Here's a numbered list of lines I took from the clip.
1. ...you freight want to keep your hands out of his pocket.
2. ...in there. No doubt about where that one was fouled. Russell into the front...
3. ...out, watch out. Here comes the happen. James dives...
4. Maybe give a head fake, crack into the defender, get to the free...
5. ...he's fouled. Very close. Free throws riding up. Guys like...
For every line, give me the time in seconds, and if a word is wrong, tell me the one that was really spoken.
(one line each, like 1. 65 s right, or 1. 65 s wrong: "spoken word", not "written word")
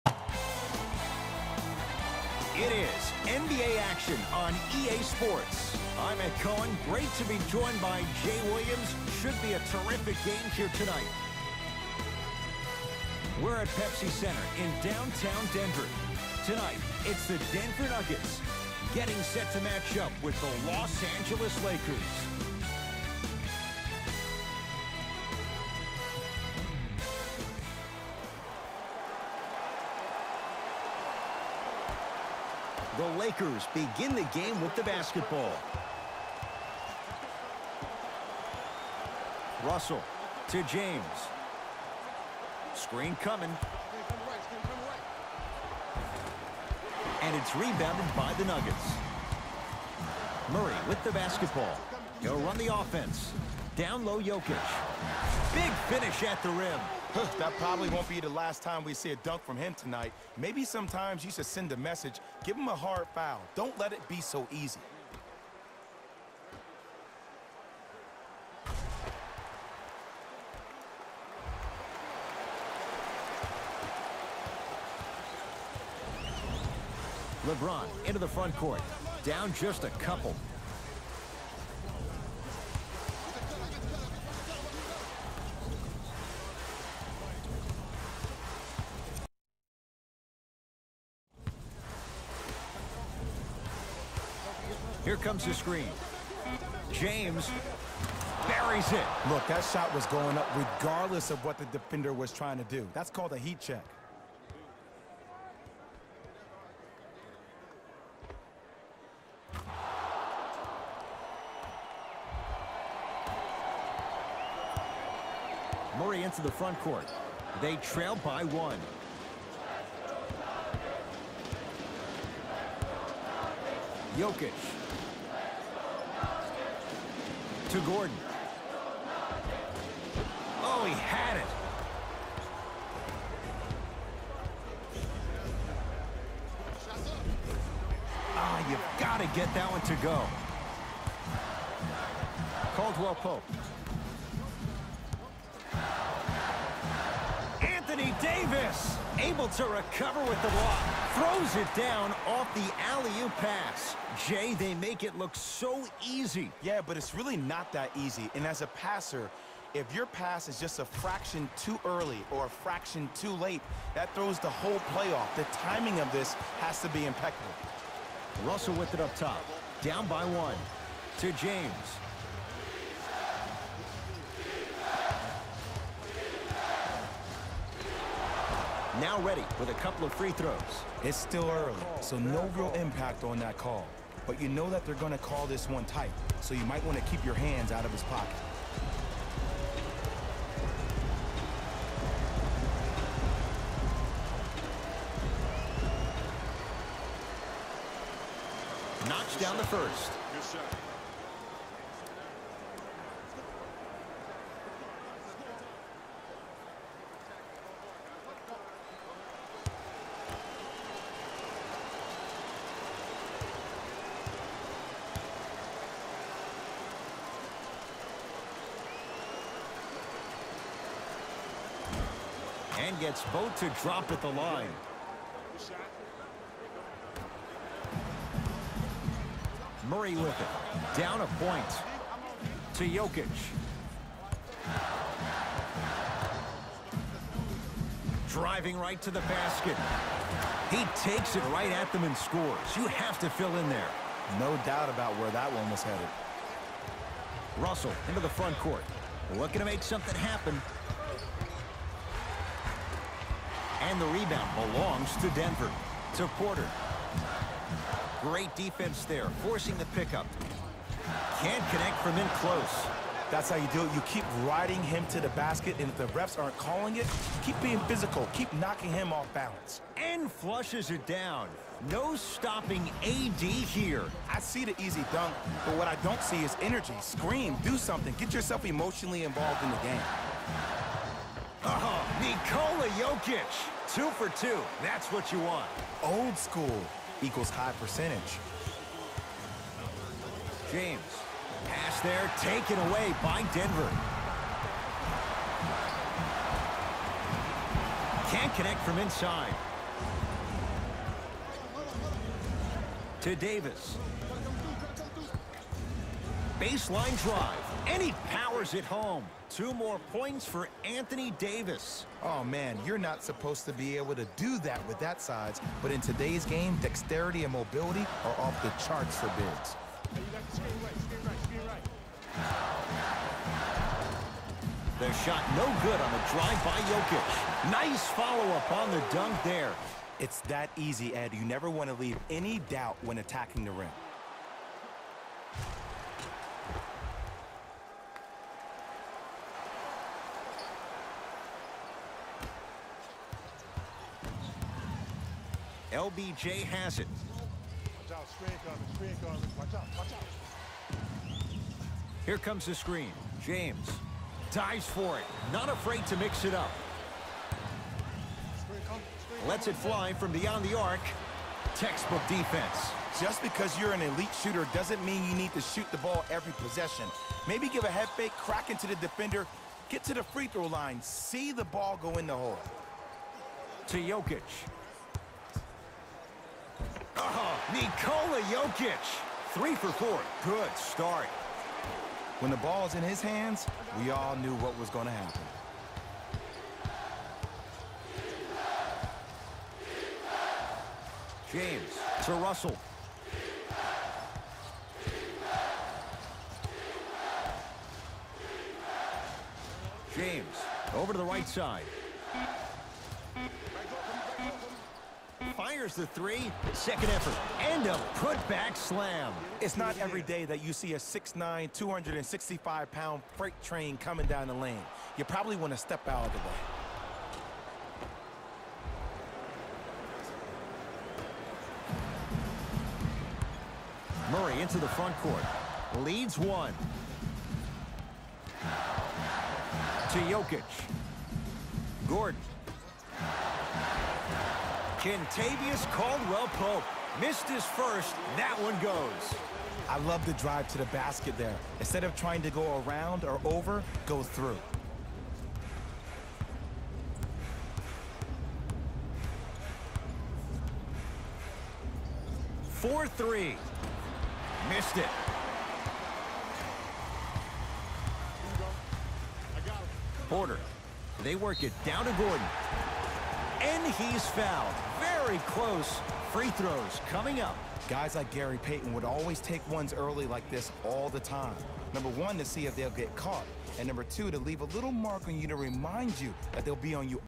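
1. 186 s wrong: "might", not "freight"
2. 243 s wrong: "headed", not "fouled"
3. 349 s wrong: "screen", not "happen"
4. 367 s right
5. 463 s wrong: "coming", not "riding".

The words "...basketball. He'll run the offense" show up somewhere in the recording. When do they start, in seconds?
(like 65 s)
51 s.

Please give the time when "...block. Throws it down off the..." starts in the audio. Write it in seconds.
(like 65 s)
150 s.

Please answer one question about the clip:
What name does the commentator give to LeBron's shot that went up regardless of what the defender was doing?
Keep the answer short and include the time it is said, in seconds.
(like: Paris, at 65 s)
heat check, at 103 s.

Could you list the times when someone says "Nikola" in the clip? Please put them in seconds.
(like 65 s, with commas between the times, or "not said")
282 s, 377 s.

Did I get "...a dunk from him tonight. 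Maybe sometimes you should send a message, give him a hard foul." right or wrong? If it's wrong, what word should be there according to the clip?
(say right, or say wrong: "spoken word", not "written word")
right.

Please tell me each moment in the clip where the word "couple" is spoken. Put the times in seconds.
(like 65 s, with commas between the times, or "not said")
79 s, 179 s.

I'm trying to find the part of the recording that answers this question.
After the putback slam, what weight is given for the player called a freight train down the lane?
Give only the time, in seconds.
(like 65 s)
411 s.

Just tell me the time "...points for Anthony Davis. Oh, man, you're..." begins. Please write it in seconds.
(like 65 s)
310 s.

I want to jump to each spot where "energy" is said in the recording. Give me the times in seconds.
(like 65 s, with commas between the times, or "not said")
276 s.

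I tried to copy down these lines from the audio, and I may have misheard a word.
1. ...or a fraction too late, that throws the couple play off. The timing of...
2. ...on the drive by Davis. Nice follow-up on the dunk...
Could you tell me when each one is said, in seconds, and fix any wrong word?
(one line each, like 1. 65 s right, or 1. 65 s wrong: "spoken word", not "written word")
1. 162 s wrong: "whole", not "couple"
2. 325 s wrong: "Jokic", not "Davis".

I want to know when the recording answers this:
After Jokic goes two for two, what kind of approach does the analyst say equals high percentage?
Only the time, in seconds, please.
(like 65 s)
286 s.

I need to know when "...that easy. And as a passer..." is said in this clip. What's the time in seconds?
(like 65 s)
157 s.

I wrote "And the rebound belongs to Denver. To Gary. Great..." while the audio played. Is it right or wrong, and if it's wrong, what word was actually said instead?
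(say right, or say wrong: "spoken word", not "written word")
wrong: "Porter", not "Gary".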